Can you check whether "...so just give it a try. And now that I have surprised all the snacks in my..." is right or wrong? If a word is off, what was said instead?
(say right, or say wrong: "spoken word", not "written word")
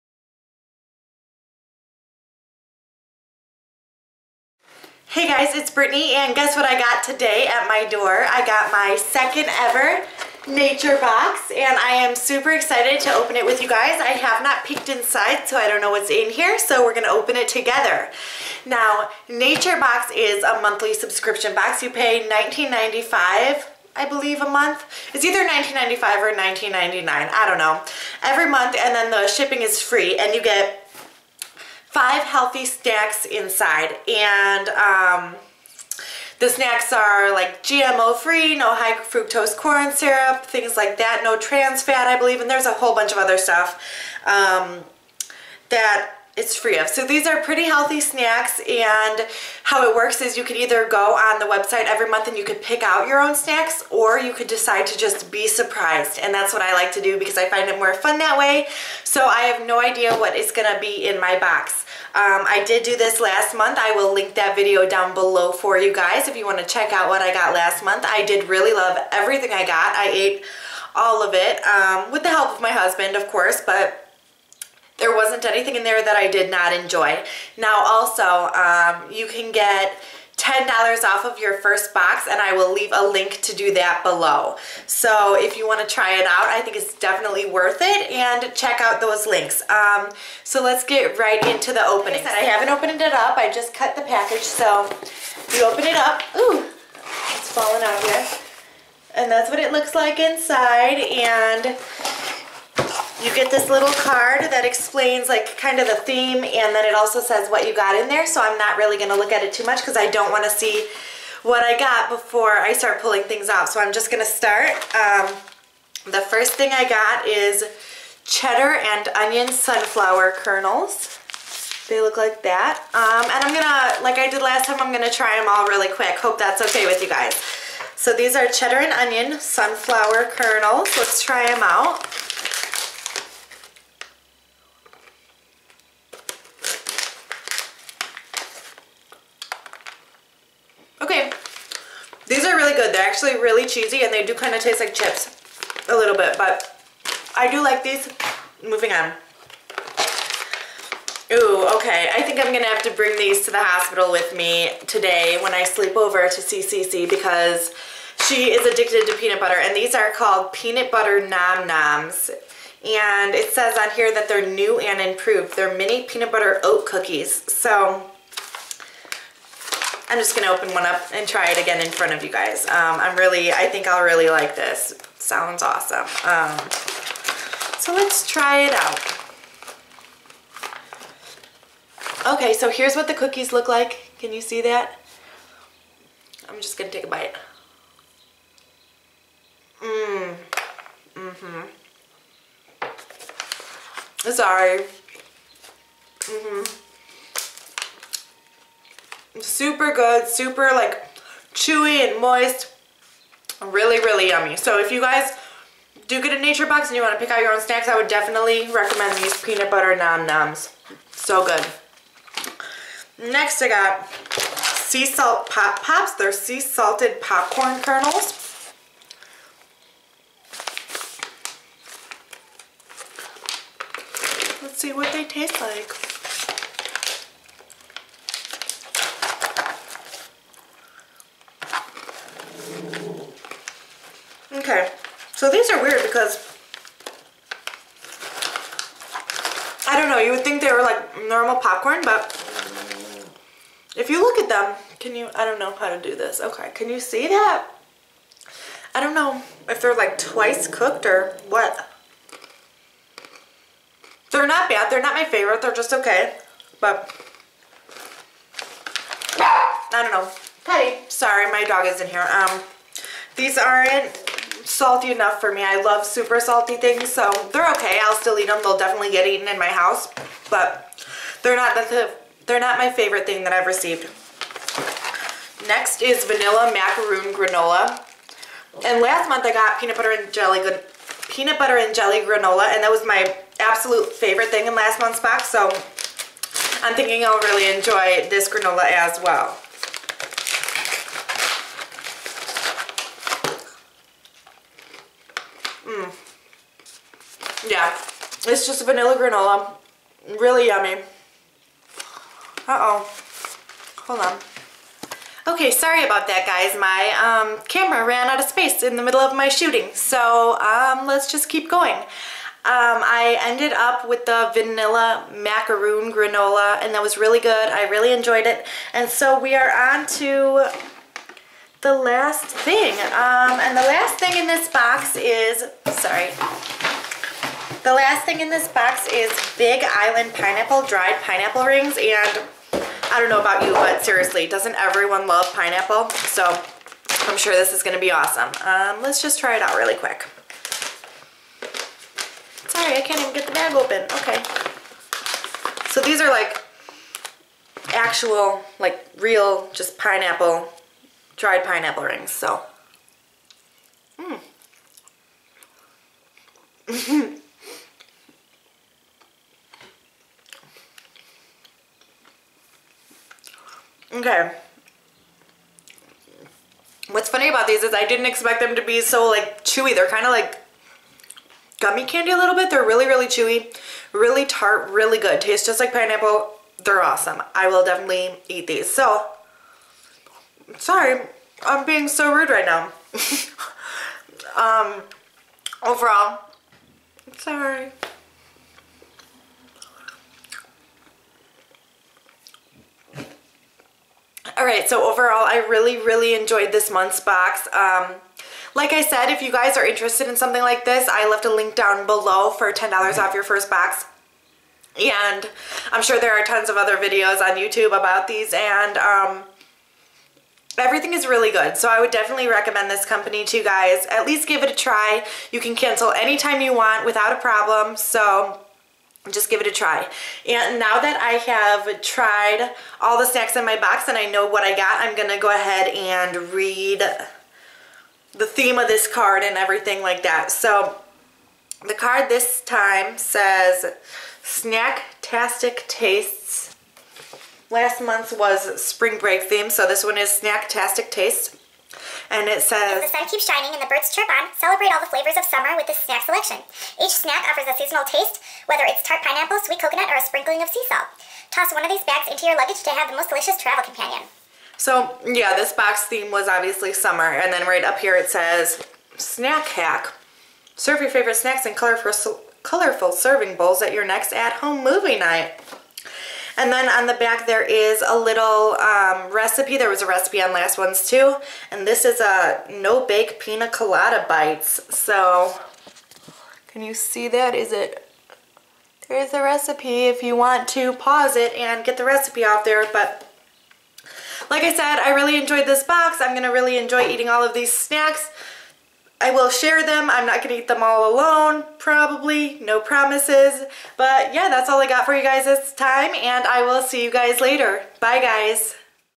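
wrong: "tried", not "surprised".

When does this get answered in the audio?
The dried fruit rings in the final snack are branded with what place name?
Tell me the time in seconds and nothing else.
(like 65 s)
329 s.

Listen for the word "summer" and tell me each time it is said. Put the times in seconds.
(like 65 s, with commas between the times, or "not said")
445 s, 456 s.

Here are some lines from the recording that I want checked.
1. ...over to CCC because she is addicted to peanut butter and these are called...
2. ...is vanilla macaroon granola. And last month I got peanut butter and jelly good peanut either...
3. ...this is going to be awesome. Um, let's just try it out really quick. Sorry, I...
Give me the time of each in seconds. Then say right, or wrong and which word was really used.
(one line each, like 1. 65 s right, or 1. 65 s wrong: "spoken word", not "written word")
1. 155 s right
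2. 276 s wrong: "butter", not "either"
3. 337 s right.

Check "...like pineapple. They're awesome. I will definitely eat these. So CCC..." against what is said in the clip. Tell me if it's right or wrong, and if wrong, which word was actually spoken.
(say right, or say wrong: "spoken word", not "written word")
wrong: "Sorry", not "CCC".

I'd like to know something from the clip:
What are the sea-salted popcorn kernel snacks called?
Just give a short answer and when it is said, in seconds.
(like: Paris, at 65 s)
Sea salt pop pops, at 214 s.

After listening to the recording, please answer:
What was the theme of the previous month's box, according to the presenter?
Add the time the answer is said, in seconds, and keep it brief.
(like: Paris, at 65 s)
Spring break, at 438 s.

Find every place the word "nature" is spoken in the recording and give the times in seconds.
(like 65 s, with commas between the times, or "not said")
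10 s, 19 s, 206 s.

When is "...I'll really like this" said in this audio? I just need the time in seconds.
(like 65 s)
173 s.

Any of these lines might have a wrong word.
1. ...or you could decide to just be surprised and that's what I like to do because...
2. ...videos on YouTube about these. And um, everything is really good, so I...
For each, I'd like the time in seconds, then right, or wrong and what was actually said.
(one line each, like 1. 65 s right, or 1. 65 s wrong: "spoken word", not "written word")
1. 53 s right
2. 406 s right.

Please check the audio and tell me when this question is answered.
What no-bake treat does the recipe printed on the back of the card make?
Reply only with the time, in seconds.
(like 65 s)
473 s.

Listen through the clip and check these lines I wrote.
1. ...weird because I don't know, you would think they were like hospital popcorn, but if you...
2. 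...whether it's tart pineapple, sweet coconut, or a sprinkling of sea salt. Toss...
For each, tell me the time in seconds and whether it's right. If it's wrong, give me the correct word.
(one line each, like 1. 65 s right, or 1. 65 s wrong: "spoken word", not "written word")
1. 235 s wrong: "normal", not "hospital"
2. 448 s right.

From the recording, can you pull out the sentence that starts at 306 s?
My um, camera ran out of space in the middle of my shooting, so um, let's just keep going.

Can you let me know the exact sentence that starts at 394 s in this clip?
All right, so overall, I really, really enjoyed this month's box.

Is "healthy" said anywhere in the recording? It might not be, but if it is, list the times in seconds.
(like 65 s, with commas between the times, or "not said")
32 s, 47 s.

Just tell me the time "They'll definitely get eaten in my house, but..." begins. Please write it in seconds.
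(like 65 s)
268 s.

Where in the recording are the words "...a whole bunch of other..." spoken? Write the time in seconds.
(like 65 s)
42 s.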